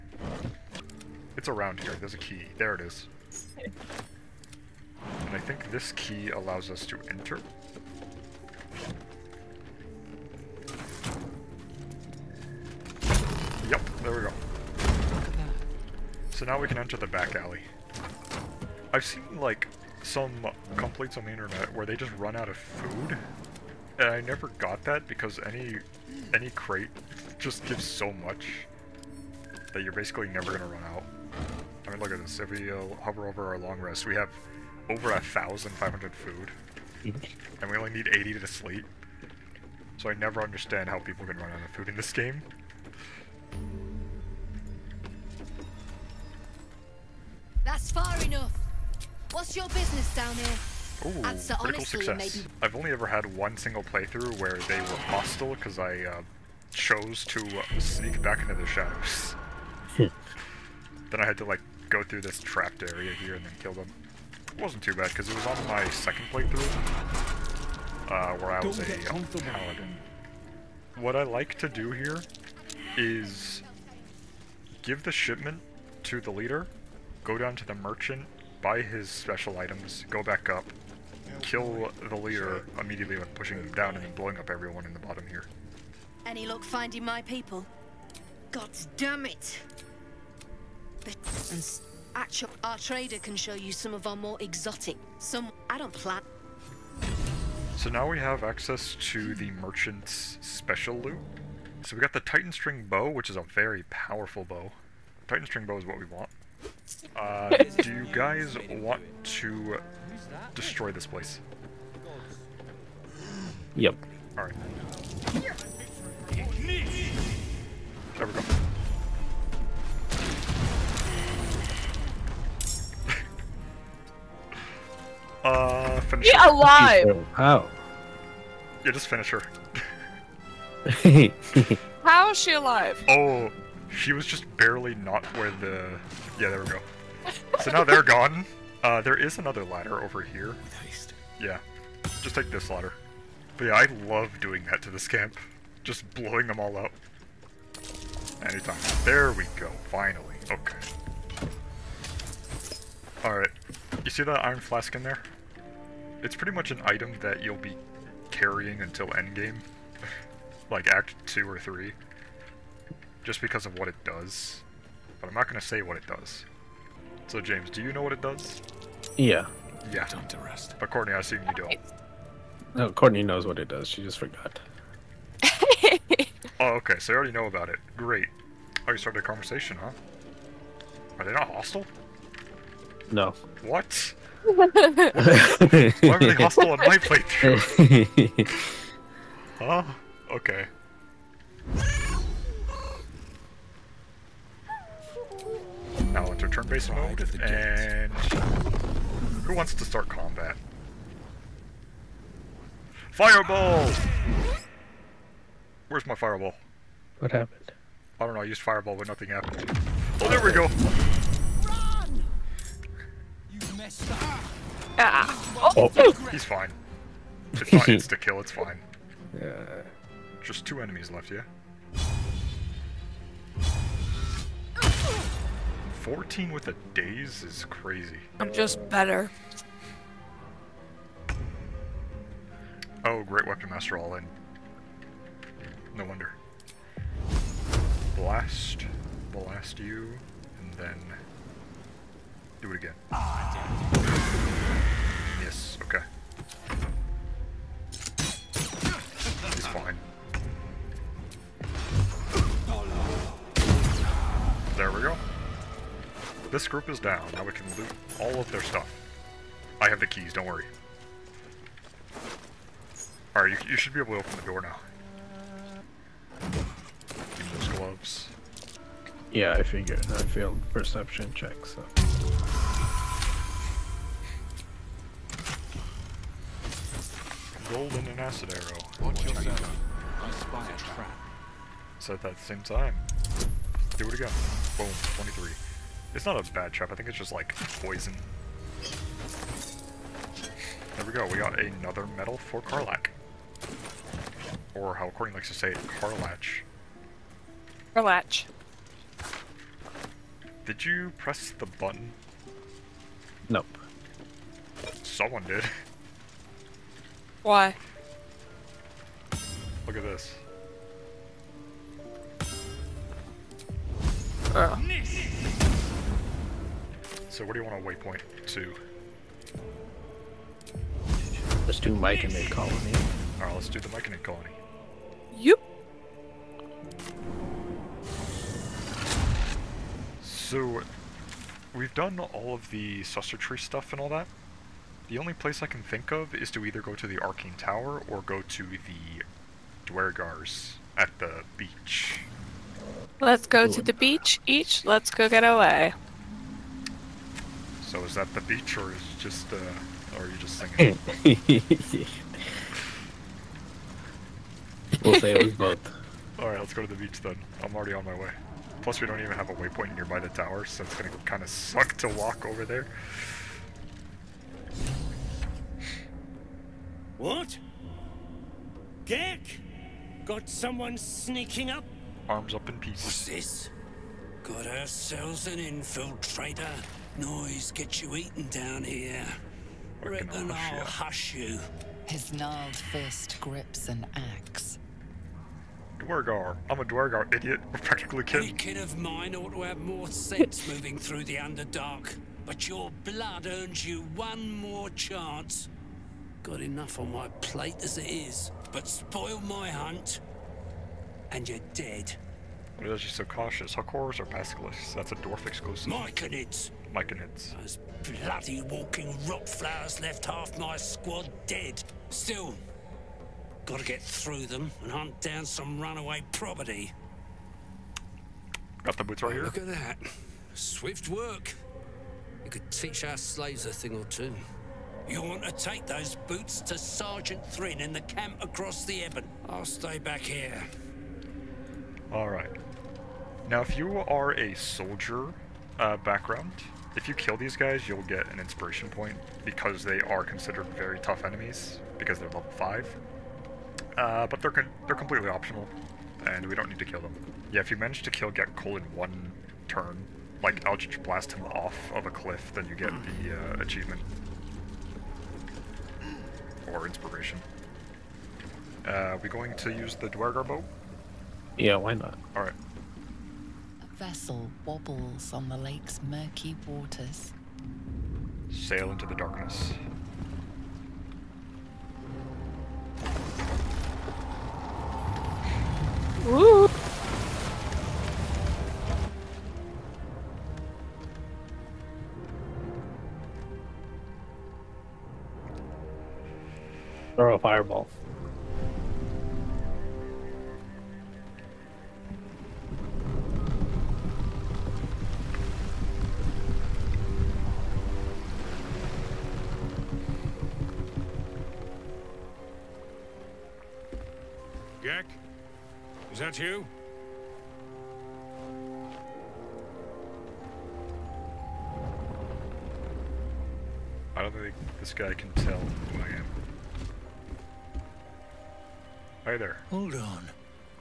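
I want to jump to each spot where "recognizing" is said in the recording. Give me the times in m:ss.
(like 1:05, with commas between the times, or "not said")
not said.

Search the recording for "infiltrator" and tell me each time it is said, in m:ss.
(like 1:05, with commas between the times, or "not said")
6:15.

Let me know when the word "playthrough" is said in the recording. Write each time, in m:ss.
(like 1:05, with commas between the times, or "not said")
0:53, 1:06, 3:06.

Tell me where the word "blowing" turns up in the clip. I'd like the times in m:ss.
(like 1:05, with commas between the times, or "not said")
1:24, 2:26.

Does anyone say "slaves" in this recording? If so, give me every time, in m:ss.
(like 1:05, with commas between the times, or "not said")
7:03.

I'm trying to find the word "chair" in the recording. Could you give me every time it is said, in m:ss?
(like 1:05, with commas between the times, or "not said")
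not said.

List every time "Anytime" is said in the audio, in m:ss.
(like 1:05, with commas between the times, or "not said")
2:28.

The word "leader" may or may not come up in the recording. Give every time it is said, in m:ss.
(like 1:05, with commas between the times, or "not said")
1:16, 1:22.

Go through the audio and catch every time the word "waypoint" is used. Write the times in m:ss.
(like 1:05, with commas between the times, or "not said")
5:17, 5:59.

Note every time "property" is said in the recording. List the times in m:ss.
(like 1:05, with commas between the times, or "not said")
6:56.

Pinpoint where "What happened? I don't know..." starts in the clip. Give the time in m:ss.
3:27.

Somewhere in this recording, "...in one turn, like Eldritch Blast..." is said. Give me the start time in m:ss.
7:28.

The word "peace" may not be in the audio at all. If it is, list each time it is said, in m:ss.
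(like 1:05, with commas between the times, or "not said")
6:12.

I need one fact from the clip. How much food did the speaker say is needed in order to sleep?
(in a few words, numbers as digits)
80.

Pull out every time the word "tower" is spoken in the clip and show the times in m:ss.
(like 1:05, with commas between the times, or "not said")
5:37, 6:00.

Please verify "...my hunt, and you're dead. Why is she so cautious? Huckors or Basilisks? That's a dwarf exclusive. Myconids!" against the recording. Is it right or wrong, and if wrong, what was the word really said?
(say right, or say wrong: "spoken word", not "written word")
right.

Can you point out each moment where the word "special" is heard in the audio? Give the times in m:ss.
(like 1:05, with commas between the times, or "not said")
1:19, 1:40.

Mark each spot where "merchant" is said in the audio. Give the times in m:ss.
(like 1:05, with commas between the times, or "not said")
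1:17, 1:39.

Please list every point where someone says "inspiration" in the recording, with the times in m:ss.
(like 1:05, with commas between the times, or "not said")
7:18, 7:36.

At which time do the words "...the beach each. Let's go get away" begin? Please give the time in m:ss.
5:43.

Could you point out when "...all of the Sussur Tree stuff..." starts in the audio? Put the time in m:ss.
5:32.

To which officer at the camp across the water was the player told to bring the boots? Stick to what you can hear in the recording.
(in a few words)
Sergeant Thrin.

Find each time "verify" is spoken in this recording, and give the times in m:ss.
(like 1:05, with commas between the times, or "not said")
not said.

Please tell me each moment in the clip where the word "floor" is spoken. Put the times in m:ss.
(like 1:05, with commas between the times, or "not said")
not said.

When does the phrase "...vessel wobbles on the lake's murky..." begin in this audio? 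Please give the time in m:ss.
7:43.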